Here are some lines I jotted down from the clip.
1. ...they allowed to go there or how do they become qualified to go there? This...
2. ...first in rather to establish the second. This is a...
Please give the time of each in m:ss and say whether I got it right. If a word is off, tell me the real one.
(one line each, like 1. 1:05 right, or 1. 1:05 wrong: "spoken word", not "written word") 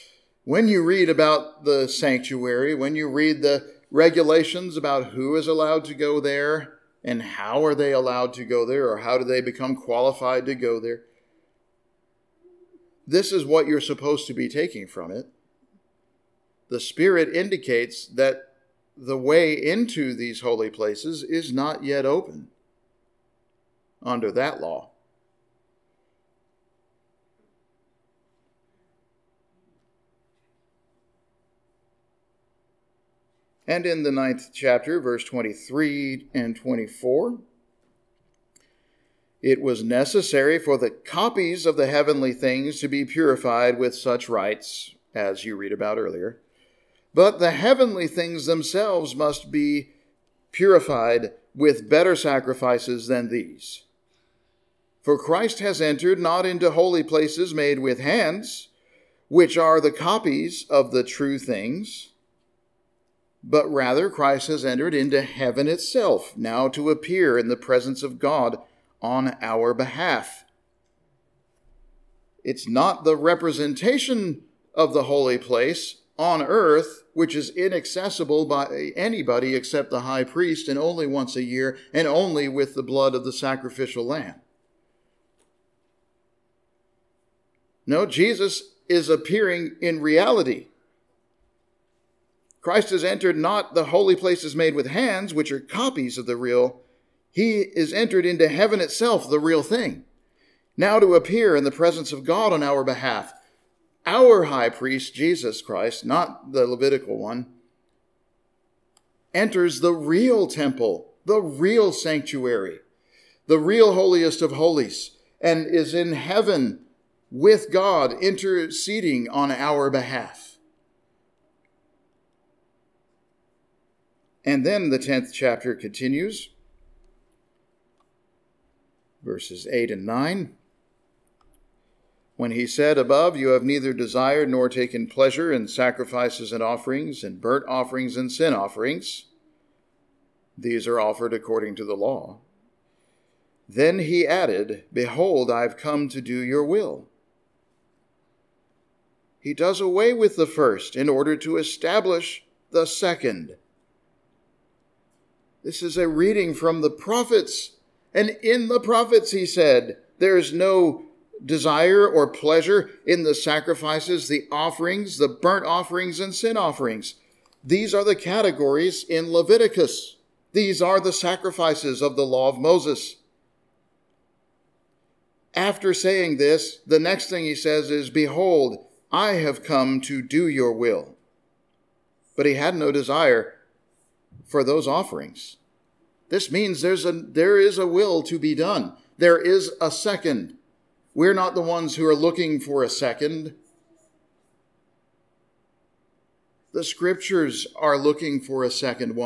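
1. 0:07 right
2. 2:30 wrong: "order", not "rather".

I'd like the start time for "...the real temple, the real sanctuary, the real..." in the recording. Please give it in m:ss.
1:49.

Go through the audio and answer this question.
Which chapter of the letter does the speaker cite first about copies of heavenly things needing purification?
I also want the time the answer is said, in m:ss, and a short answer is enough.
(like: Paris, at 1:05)
Ninth chapter, at 0:34.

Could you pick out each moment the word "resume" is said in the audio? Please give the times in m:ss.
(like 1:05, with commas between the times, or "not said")
not said.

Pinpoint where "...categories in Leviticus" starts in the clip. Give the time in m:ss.
2:48.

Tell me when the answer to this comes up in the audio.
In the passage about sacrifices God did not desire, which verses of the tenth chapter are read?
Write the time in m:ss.
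2:09.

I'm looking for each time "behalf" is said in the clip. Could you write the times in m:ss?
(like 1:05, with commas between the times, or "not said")
1:09, 1:42, 1:59.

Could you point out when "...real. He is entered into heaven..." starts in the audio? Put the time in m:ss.
1:36.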